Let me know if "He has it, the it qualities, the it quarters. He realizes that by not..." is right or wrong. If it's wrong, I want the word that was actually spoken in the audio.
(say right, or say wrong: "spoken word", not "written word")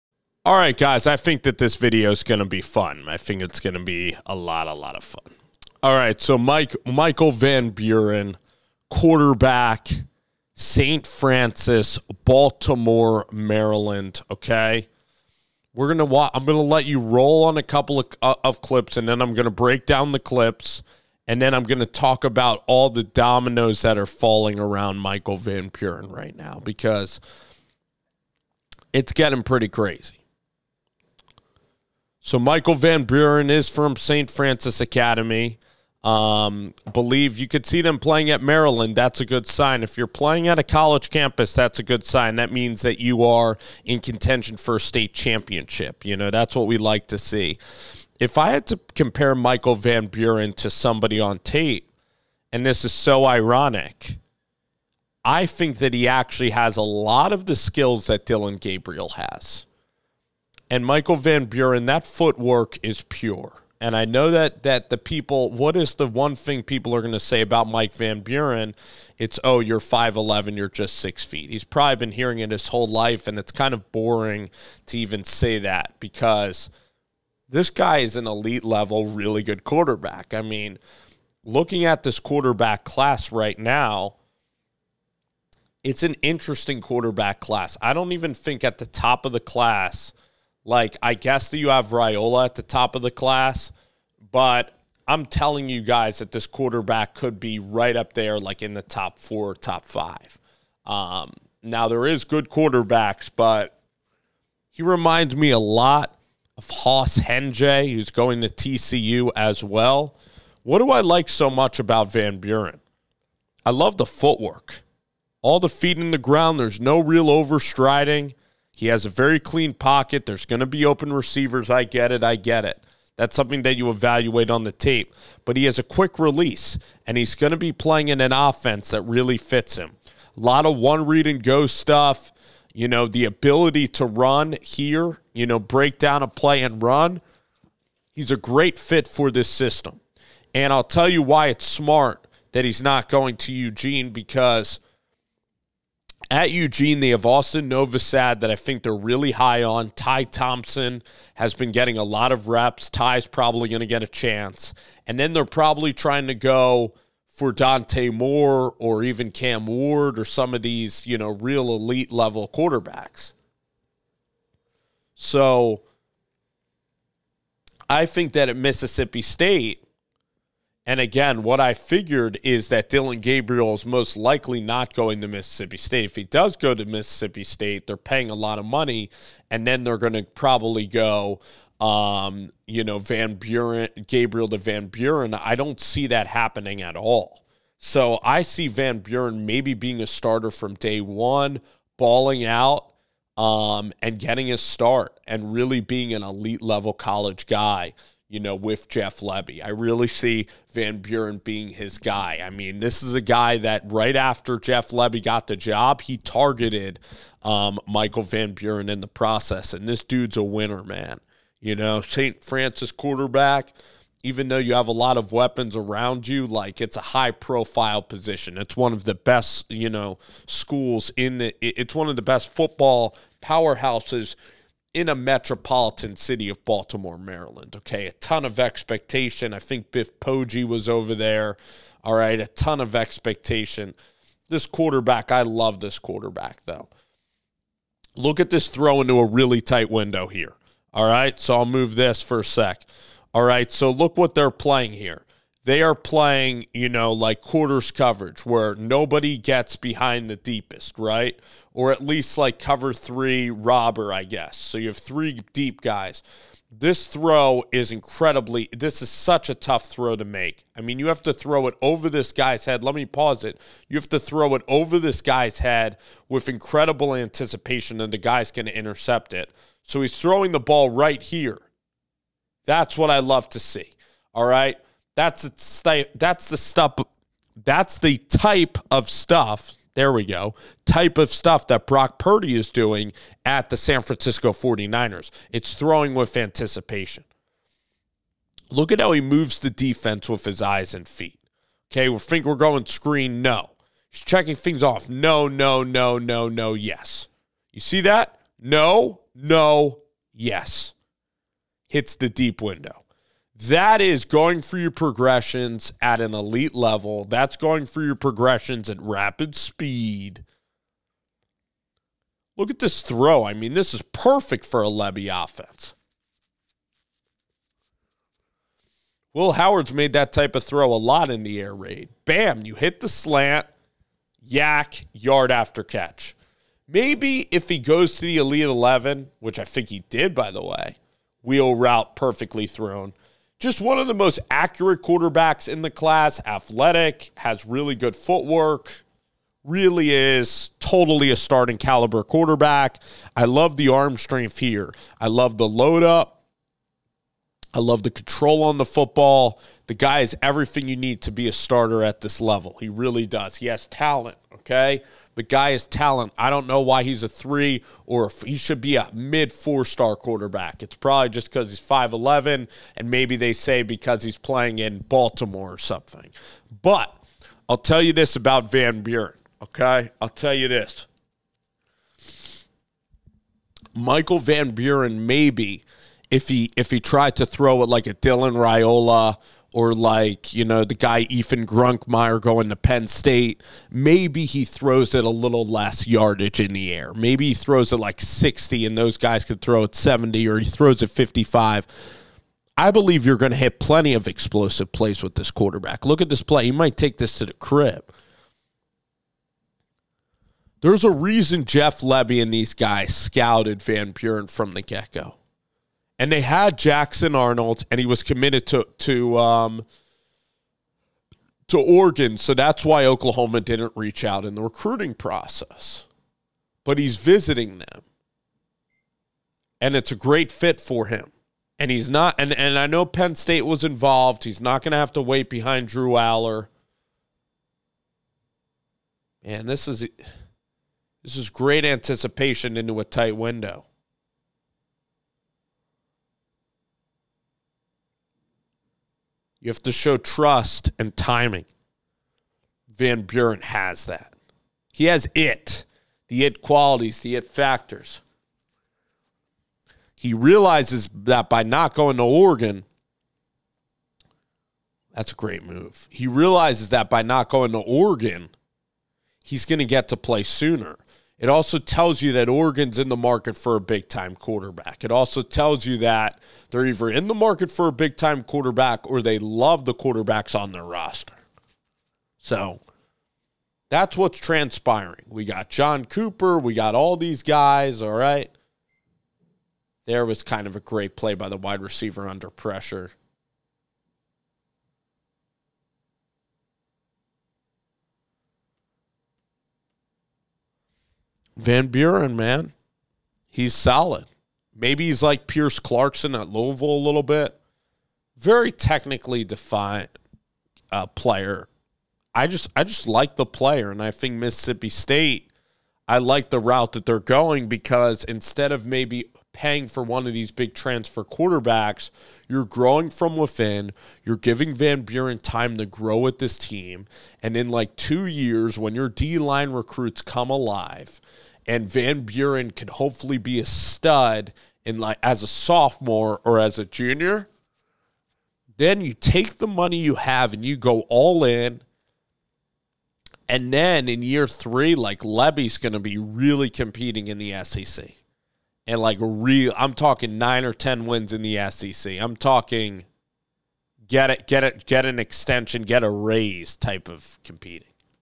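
wrong: "factors", not "quarters".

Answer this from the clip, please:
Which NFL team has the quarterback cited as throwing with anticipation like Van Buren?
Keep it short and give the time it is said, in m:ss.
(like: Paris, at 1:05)
San Francisco 49ers, at 4:43.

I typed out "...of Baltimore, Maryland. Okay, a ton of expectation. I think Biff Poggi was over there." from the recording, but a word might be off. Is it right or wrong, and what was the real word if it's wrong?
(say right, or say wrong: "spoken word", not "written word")
right.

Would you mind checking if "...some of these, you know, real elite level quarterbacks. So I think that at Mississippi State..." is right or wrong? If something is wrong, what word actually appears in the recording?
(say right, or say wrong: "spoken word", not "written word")
right.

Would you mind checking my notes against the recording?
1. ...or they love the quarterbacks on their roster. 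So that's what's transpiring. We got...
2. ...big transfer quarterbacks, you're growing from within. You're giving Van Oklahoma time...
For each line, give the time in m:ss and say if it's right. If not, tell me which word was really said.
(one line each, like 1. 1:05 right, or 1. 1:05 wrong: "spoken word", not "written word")
1. 7:49 right
2. 8:30 wrong: "Buren", not "Oklahoma".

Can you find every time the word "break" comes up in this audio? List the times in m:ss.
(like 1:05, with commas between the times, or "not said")
0:19, 2:15.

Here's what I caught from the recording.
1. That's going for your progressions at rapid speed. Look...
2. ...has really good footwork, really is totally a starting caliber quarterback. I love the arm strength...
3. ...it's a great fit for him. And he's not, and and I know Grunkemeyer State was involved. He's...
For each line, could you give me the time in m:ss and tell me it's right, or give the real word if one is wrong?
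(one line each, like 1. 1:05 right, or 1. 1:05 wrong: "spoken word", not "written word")
1. 5:07 right
2. 5:37 right
3. 6:59 wrong: "Penn", not "Grunkemeyer".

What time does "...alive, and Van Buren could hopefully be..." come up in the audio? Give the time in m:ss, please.
8:40.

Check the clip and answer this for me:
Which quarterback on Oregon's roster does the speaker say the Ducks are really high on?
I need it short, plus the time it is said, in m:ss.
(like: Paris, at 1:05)
Austin Novosad, at 2:27.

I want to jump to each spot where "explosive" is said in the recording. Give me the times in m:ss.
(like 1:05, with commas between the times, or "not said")
6:34.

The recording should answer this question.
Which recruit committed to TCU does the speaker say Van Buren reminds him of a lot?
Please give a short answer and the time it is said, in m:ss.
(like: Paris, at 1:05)
Hauss Hejny, at 1:46.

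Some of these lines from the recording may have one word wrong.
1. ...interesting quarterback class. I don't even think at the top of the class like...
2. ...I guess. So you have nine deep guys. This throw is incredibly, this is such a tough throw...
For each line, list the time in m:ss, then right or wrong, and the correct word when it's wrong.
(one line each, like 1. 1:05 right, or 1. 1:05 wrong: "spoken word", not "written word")
1. 1:26 right
2. 4:14 wrong: "three", not "nine".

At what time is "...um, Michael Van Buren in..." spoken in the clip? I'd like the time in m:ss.
3:27.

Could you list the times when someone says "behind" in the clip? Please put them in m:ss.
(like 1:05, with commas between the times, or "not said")
4:09, 7:05.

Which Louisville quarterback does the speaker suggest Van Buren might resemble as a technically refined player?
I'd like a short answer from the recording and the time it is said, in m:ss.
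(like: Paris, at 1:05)
Pierce Clarkson, at 8:15.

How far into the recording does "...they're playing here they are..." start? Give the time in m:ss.
4:04.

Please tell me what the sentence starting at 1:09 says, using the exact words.
It's oh, you're five eleven, you're just six feet.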